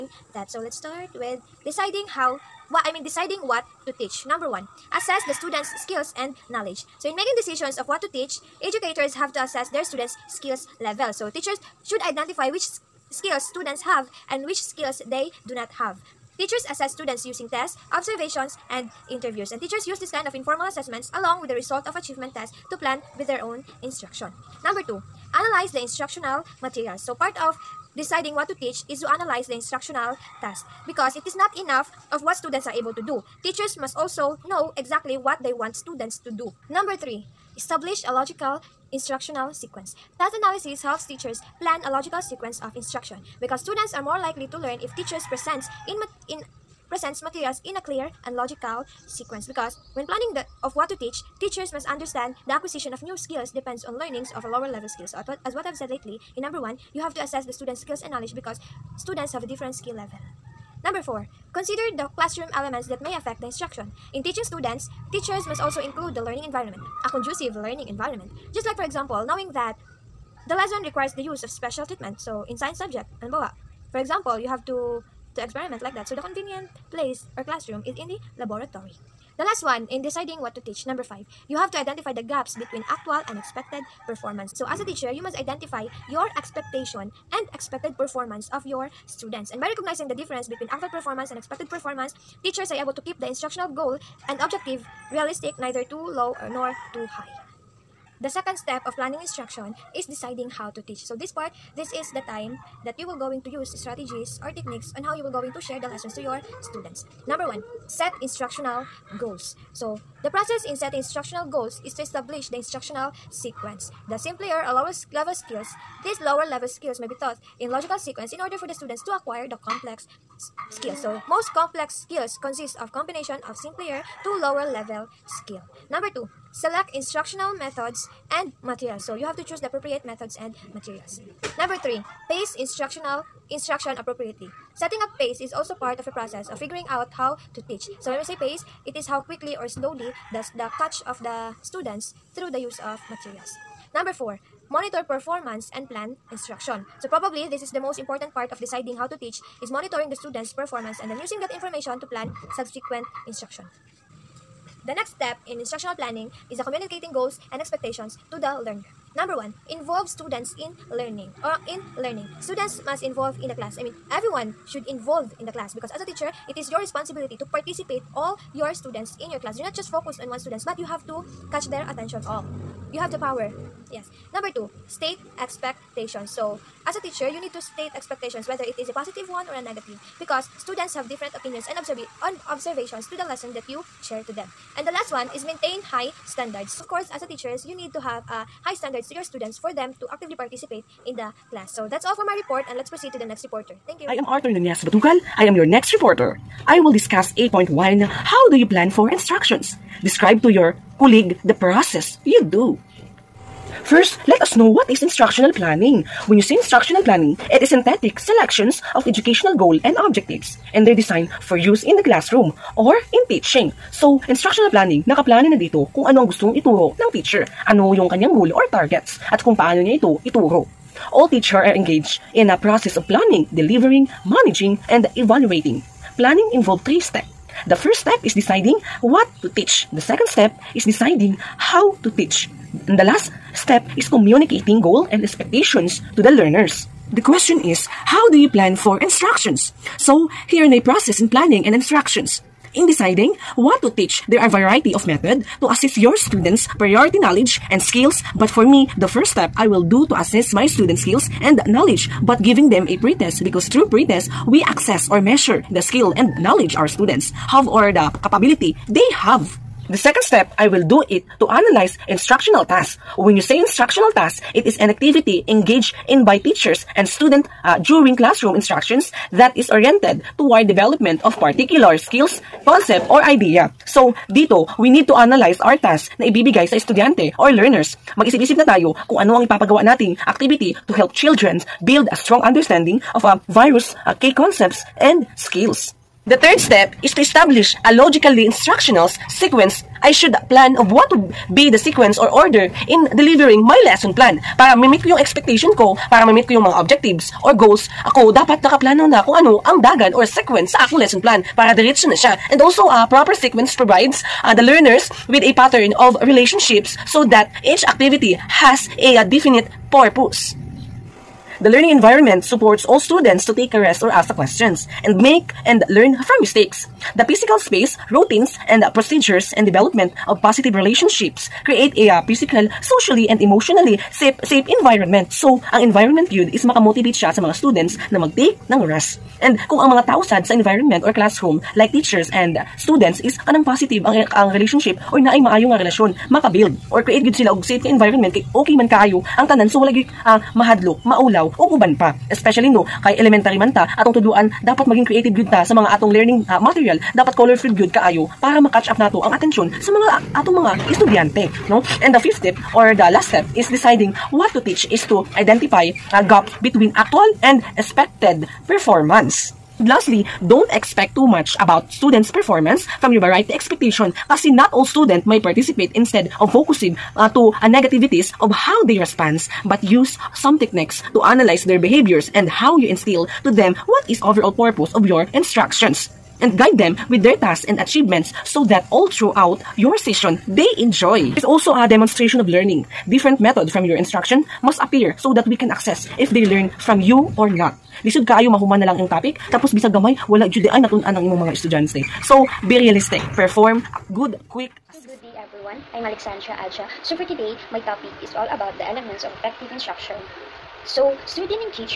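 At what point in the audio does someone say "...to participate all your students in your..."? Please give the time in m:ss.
2:47.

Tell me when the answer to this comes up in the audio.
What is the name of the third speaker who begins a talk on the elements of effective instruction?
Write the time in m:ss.
6:36.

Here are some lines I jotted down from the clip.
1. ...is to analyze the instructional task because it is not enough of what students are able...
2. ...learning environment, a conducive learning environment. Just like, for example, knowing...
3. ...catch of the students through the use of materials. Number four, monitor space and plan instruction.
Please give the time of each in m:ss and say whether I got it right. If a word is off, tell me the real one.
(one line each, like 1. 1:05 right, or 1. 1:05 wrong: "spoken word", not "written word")
1. 0:28 right
2. 1:06 right
3. 2:20 wrong: "performance", not "space".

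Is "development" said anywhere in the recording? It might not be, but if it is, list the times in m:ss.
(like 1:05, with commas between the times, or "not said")
4:30, 5:19.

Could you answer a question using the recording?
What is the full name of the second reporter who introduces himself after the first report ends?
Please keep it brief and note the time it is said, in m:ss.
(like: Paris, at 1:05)
Arthur Nunez Batugal, at 3:14.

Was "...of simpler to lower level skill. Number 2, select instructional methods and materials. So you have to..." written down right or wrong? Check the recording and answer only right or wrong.
right.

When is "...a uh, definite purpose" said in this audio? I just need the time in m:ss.
5:09.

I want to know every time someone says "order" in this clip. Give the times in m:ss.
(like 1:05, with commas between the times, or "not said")
1:58, 4:52.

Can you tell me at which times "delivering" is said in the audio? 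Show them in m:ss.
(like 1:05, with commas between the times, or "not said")
3:43, 4:53.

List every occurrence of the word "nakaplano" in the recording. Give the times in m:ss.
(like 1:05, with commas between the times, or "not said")
3:35, 4:58.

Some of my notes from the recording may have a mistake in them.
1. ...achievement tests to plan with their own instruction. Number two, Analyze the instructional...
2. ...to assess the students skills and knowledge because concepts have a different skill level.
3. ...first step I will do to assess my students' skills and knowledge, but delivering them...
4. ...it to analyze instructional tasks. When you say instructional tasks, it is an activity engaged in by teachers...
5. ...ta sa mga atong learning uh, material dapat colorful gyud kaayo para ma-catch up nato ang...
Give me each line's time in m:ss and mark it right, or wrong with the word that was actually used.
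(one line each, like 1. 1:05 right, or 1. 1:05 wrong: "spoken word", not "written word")
1. 0:21 right
2. 0:57 wrong: "students", not "concepts"
3. 4:09 wrong: "giving", not "delivering"
4. 4:21 right
5. 5:45 right.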